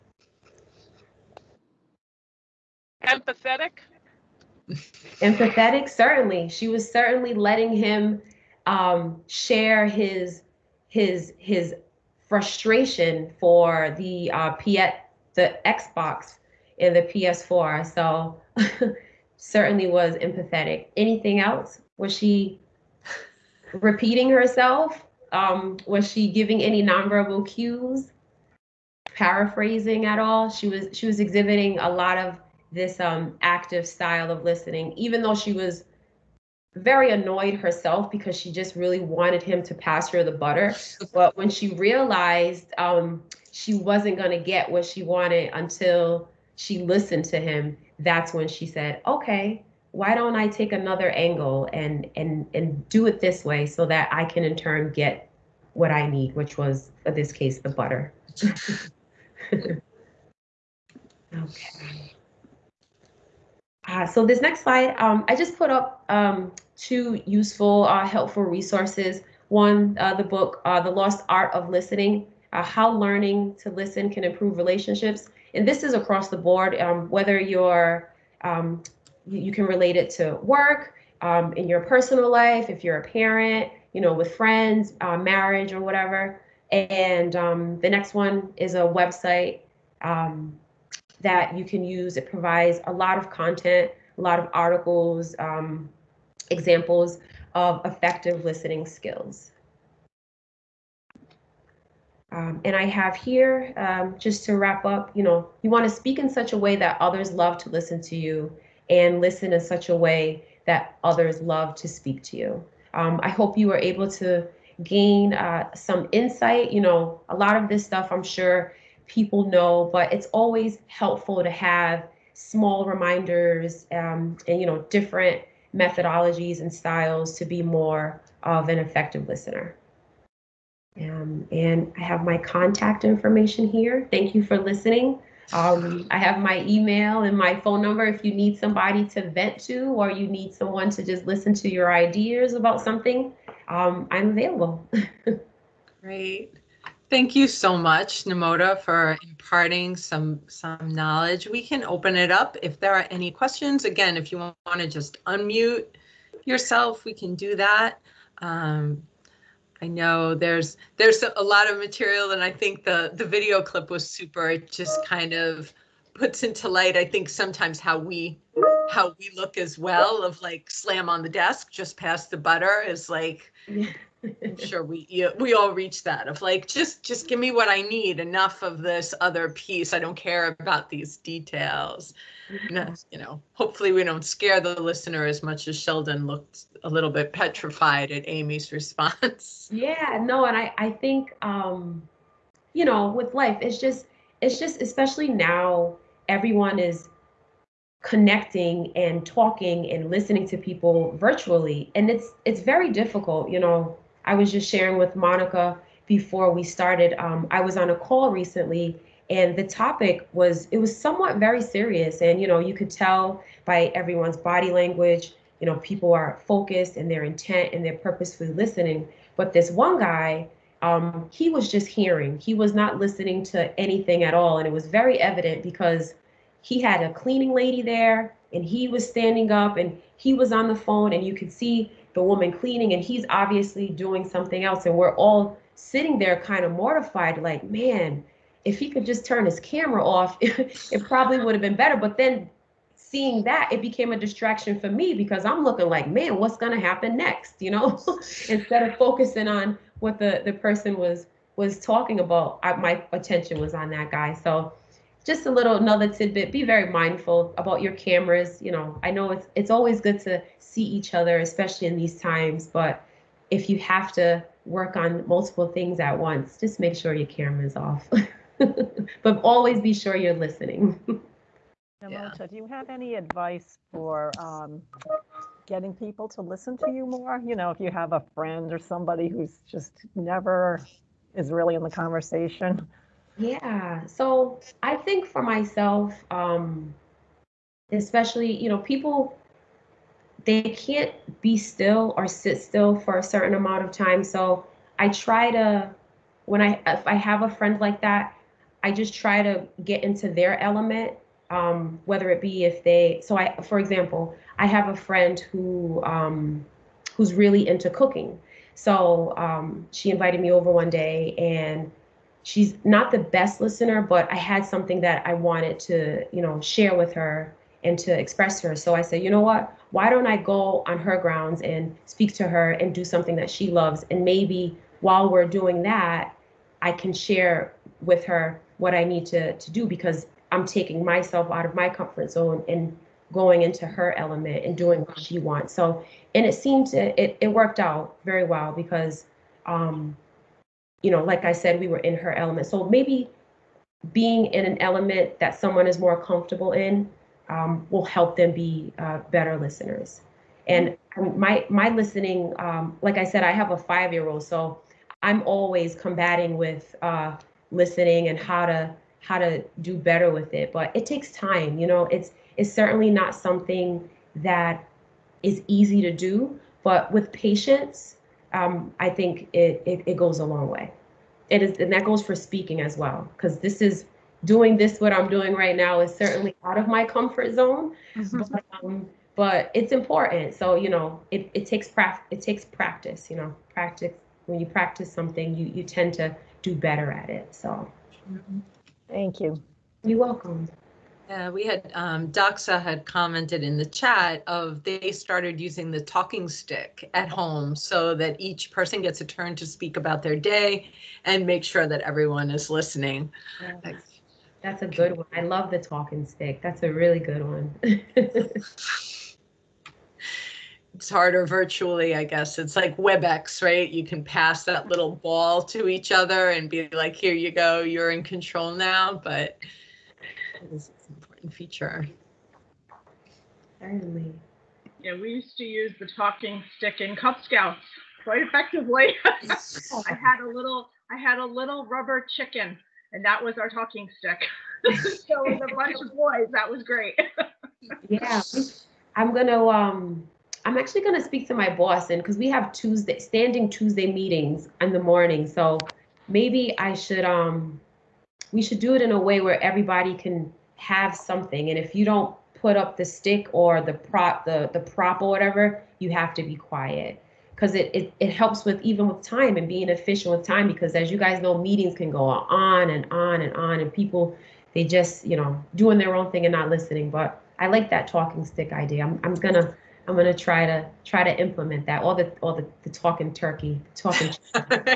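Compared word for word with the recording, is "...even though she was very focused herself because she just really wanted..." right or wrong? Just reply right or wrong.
wrong.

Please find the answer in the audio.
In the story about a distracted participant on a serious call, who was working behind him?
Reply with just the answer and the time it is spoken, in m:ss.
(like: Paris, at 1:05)
a cleaning lady, at 3:47.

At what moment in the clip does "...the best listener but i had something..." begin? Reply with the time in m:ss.
5:13.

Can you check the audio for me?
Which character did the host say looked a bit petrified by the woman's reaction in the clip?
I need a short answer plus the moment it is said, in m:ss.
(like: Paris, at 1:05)
Sheldon, at 3:05.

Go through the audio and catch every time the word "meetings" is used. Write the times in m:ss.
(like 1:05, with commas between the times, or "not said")
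7:24, 7:41.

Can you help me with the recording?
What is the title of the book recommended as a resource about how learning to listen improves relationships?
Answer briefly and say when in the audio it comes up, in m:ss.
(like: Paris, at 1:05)
The Lost Art of Listening, at 1:10.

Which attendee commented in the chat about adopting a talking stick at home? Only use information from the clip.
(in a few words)
Doxa.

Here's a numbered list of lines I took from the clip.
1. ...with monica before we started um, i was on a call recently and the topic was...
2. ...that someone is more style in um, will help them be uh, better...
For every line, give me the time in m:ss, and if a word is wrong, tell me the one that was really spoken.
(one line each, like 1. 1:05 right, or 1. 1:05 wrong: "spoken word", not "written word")
1. 3:24 right
2. 5:45 wrong: "comfortable", not "style".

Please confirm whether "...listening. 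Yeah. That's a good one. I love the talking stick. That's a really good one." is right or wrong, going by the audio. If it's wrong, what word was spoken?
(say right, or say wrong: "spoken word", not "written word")
right.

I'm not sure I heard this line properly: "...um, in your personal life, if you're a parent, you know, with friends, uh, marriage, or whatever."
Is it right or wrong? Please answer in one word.
right.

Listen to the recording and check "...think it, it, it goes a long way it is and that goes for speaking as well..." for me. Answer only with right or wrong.
right.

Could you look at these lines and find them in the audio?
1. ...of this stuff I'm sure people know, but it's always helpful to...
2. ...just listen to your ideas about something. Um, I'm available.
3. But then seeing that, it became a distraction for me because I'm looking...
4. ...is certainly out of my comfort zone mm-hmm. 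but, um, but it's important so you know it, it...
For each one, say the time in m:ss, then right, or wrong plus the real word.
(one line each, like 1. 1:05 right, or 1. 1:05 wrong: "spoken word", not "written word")
1. 1:57 right
2. 2:21 right
3. 4:01 right
4. 6:15 right.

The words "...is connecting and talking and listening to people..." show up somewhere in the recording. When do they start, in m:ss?
3:16.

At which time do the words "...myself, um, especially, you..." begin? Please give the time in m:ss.
4:45.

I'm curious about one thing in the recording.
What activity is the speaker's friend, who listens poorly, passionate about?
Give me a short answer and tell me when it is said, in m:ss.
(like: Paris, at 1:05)
cooking, at 5:07.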